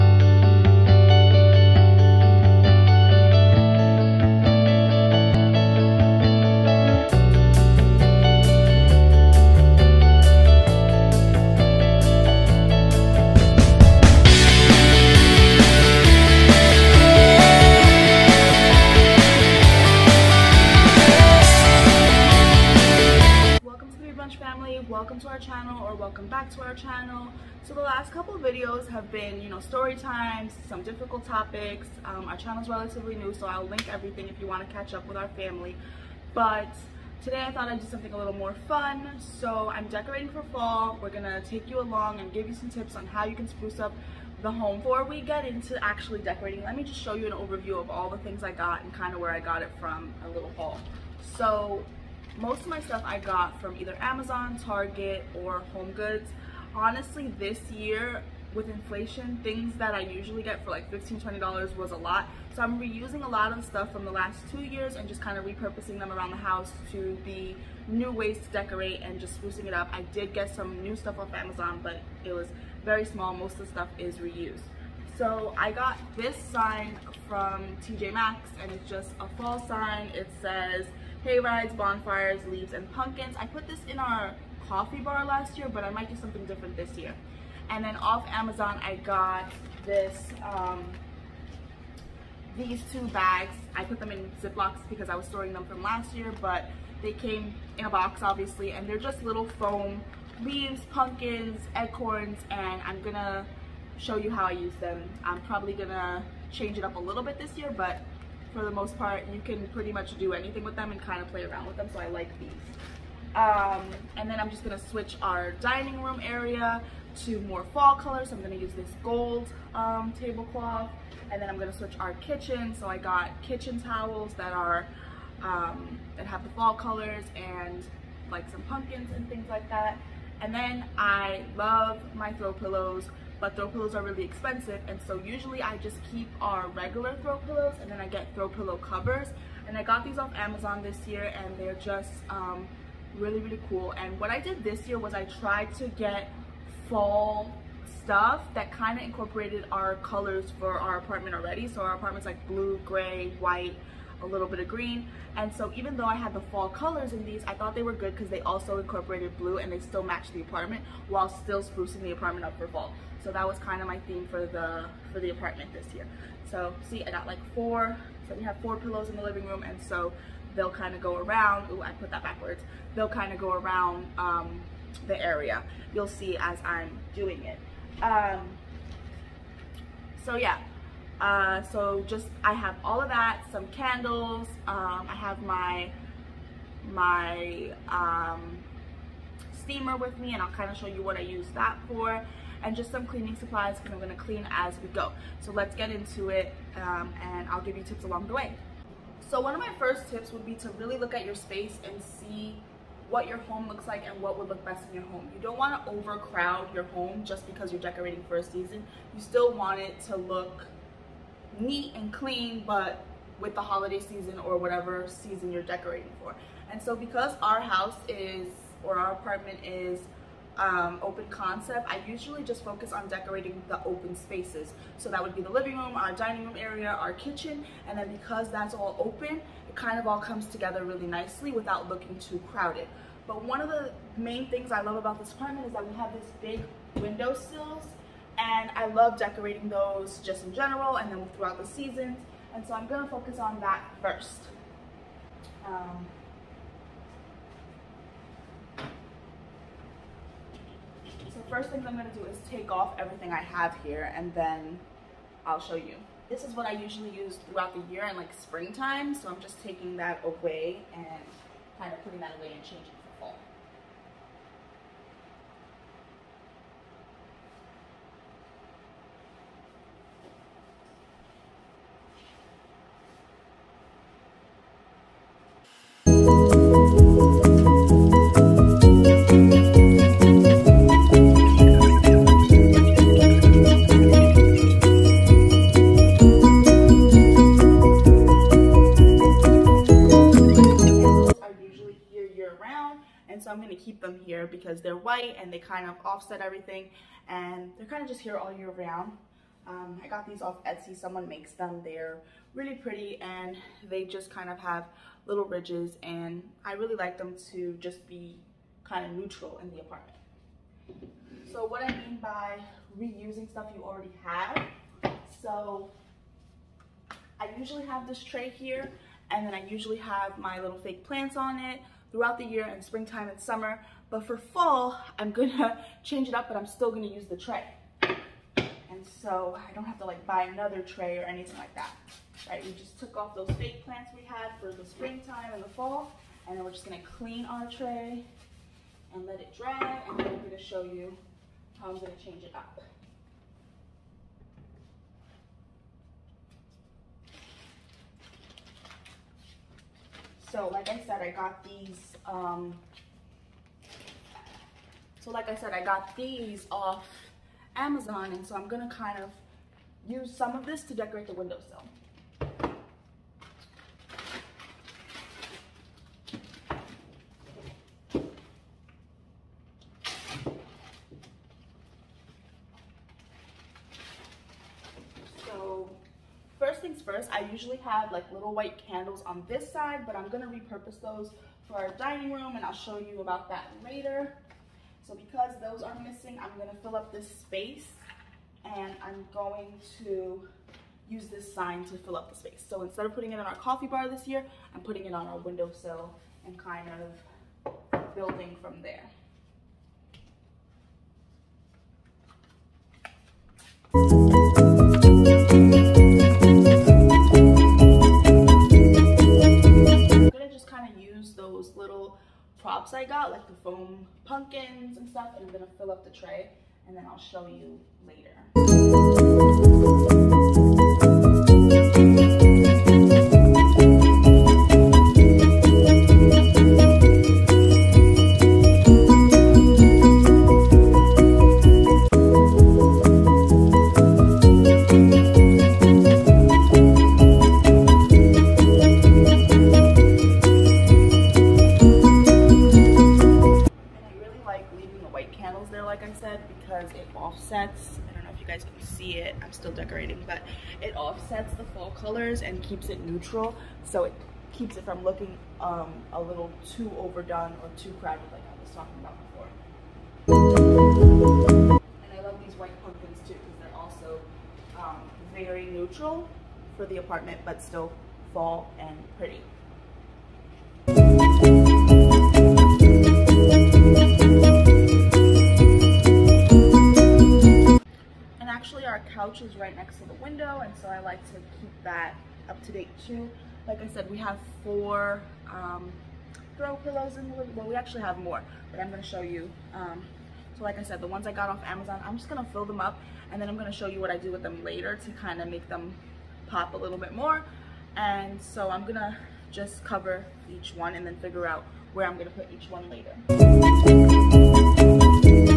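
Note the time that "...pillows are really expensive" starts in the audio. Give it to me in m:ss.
2:13.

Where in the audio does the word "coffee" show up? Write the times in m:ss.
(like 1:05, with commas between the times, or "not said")
1:24, 6:33.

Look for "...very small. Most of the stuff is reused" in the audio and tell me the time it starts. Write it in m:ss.
1:12.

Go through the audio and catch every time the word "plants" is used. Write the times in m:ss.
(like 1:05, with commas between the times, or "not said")
5:21, 5:33.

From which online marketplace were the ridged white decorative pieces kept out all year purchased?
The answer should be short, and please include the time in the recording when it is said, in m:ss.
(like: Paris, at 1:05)
Etsy, at 5:00.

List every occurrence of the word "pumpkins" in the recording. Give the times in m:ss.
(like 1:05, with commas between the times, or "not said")
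1:22, 1:40, 2:08, 6:54, 7:42.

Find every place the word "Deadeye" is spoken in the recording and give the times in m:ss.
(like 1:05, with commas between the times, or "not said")
not said.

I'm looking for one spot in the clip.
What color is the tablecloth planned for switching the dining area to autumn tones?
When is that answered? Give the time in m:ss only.
1:59.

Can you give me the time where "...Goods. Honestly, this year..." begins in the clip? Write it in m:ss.
0:55.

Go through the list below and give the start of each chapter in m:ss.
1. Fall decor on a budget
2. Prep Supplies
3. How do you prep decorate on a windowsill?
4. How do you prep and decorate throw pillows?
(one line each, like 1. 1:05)
1. 0:49
2. 3:03
3. 3:57
4. 8:07.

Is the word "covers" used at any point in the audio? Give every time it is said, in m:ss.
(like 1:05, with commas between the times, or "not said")
2:18, 8:19.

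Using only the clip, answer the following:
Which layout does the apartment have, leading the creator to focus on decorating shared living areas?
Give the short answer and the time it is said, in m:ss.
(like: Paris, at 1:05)
open concept, at 3:41.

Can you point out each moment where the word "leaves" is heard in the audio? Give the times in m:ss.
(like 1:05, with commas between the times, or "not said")
1:22, 1:40.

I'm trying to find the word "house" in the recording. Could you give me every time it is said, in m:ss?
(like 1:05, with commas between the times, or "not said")
1:06, 3:37.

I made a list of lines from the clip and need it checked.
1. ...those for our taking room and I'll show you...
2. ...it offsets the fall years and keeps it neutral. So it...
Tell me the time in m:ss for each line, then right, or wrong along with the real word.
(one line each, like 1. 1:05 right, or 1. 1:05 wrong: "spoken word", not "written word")
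1. 6:20 wrong: "dining", not "taking"
2. 7:30 wrong: "colors", not "years".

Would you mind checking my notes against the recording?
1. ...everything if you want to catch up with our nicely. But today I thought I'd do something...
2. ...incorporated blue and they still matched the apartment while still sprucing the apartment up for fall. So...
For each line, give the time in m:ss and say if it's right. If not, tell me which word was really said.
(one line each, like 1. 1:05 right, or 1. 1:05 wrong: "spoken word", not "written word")
1. 0:33 wrong: "family", not "nicely"
2. 2:38 right.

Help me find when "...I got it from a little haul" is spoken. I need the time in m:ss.
0:49.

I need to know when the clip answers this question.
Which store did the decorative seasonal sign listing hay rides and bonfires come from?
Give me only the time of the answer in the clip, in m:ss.
1:17.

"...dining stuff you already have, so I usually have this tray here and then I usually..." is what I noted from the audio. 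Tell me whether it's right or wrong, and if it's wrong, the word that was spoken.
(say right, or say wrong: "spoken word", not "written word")
wrong: "reusing", not "dining".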